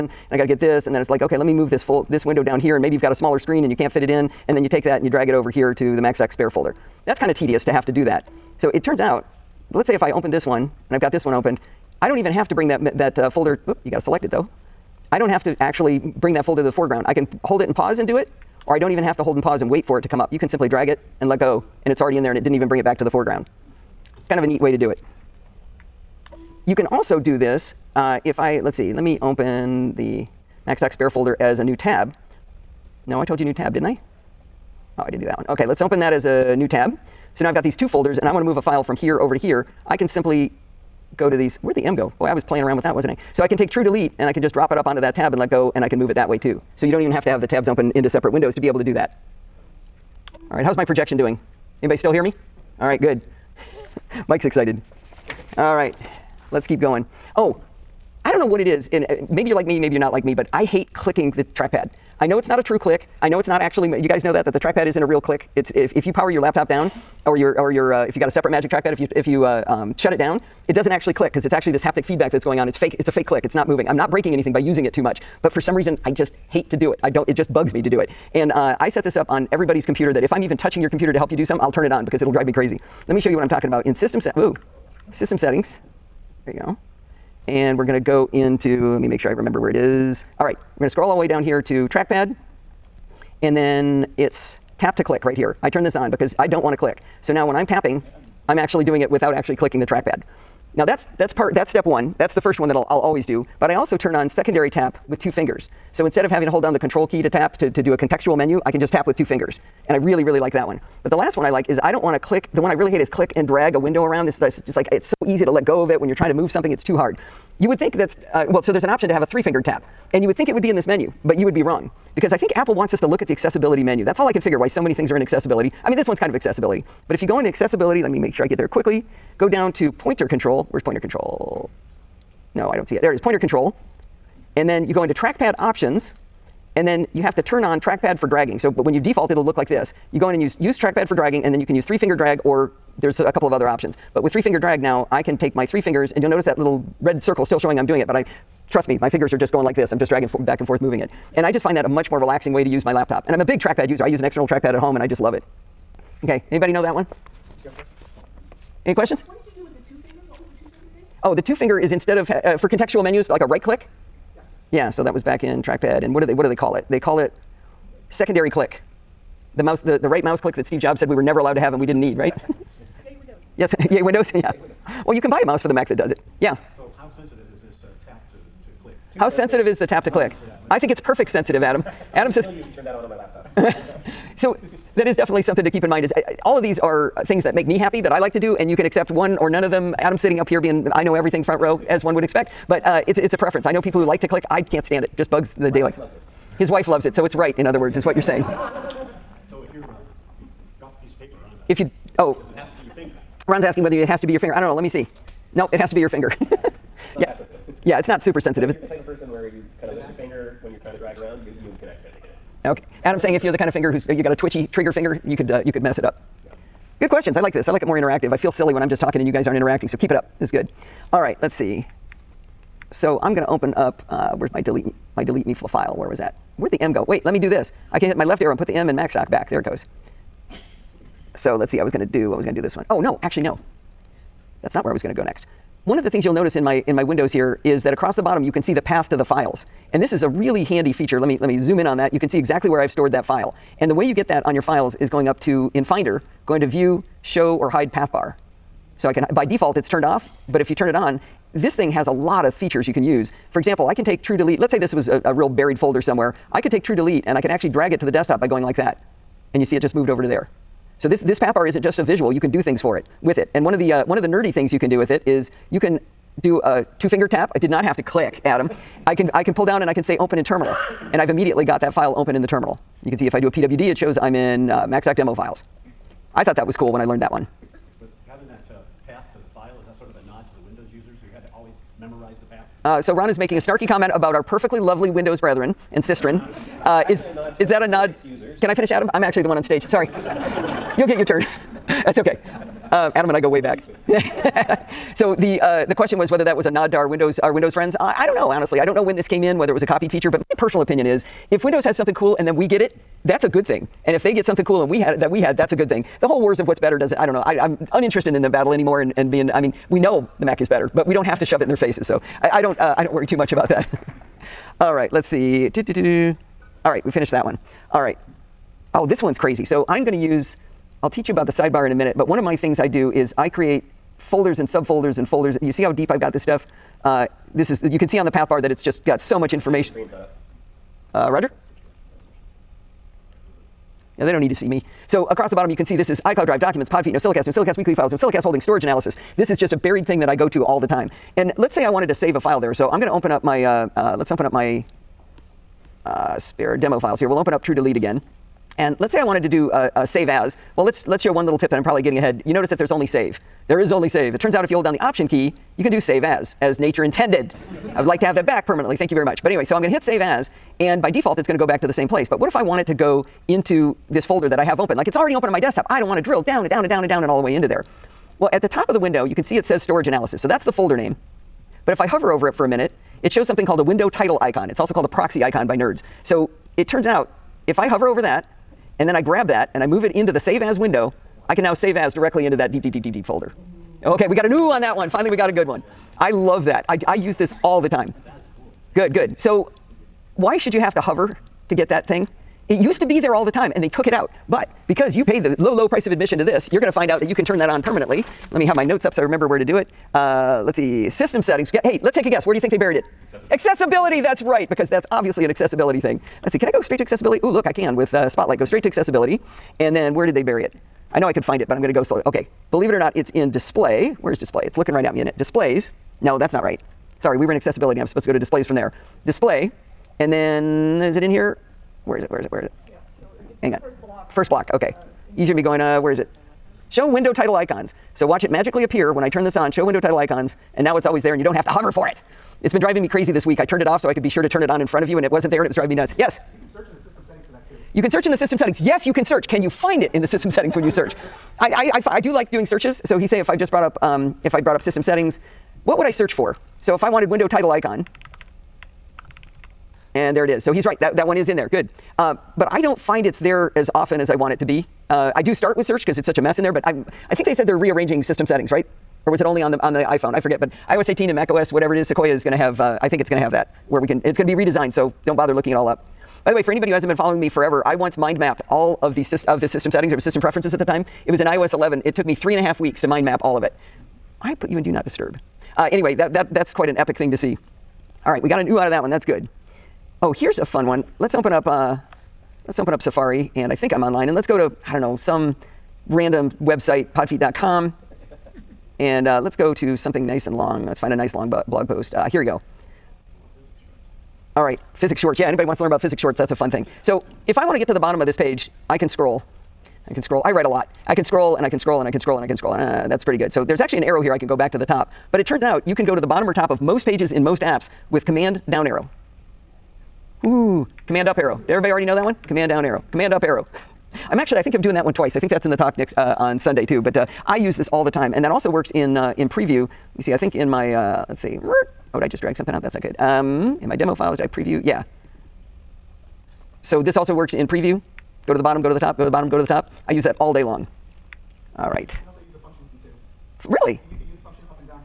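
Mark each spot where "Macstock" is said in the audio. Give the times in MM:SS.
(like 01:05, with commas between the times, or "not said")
00:06, 00:30, 03:48, 04:34.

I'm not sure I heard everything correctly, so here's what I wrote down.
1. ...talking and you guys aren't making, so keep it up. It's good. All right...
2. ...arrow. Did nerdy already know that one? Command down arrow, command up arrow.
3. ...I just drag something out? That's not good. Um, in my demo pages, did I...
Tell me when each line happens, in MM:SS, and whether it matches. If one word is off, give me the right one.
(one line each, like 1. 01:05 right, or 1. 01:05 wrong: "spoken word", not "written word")
1. 03:39 wrong: "interacting", not "making"
2. 08:31 wrong: "everybody", not "nerdy"
3. 08:42 wrong: "files", not "pages".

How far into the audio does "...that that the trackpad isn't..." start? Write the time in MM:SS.
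01:04.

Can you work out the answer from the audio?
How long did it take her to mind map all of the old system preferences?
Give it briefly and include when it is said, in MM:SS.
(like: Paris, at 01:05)
three and a half weeks, at 07:52.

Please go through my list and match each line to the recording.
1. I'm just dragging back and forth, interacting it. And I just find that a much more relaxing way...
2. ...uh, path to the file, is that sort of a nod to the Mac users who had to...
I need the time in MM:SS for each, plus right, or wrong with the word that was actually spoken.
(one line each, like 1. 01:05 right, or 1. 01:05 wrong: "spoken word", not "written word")
1. 02:29 wrong: "moving", not "interacting"
2. 04:38 wrong: "Windows", not "Mac".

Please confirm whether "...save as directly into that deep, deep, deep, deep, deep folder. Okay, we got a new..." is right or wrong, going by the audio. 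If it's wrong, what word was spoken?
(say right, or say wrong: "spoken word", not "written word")
right.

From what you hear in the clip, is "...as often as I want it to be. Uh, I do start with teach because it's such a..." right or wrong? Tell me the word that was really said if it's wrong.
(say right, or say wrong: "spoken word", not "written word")
wrong: "search", not "teach".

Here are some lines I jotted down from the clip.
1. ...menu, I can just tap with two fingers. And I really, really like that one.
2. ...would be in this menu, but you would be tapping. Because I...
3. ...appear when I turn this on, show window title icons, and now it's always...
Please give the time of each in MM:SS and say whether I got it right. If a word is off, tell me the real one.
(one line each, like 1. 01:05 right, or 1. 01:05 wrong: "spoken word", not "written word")
1. 01:48 right
2. 02:00 wrong: "wrong", not "tapping"
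3. 07:08 right.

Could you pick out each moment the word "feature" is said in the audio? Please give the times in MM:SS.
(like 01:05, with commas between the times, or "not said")
04:00, 04:12, 05:00.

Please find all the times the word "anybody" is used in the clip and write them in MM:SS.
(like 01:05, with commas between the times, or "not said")
00:51, 02:36, 07:46, 08:15.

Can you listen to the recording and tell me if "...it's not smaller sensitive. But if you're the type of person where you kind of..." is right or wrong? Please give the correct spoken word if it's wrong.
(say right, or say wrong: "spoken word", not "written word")
wrong: "super", not "smaller".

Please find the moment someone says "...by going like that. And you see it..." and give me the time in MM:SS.
04:18.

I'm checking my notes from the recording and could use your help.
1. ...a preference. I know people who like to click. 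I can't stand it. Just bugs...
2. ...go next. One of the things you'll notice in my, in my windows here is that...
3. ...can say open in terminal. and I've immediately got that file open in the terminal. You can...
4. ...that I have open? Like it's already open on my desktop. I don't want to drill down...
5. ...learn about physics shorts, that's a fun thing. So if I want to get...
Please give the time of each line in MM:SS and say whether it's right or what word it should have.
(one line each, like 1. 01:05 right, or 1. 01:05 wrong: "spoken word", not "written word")
1. 03:13 right
2. 03:55 right
3. 04:29 right
4. 06:04 right
5. 08:15 right.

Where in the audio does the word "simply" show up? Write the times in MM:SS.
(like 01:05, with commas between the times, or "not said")
00:20, 00:40.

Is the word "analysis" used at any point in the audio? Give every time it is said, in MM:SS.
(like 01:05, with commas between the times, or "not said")
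05:38, 06:10.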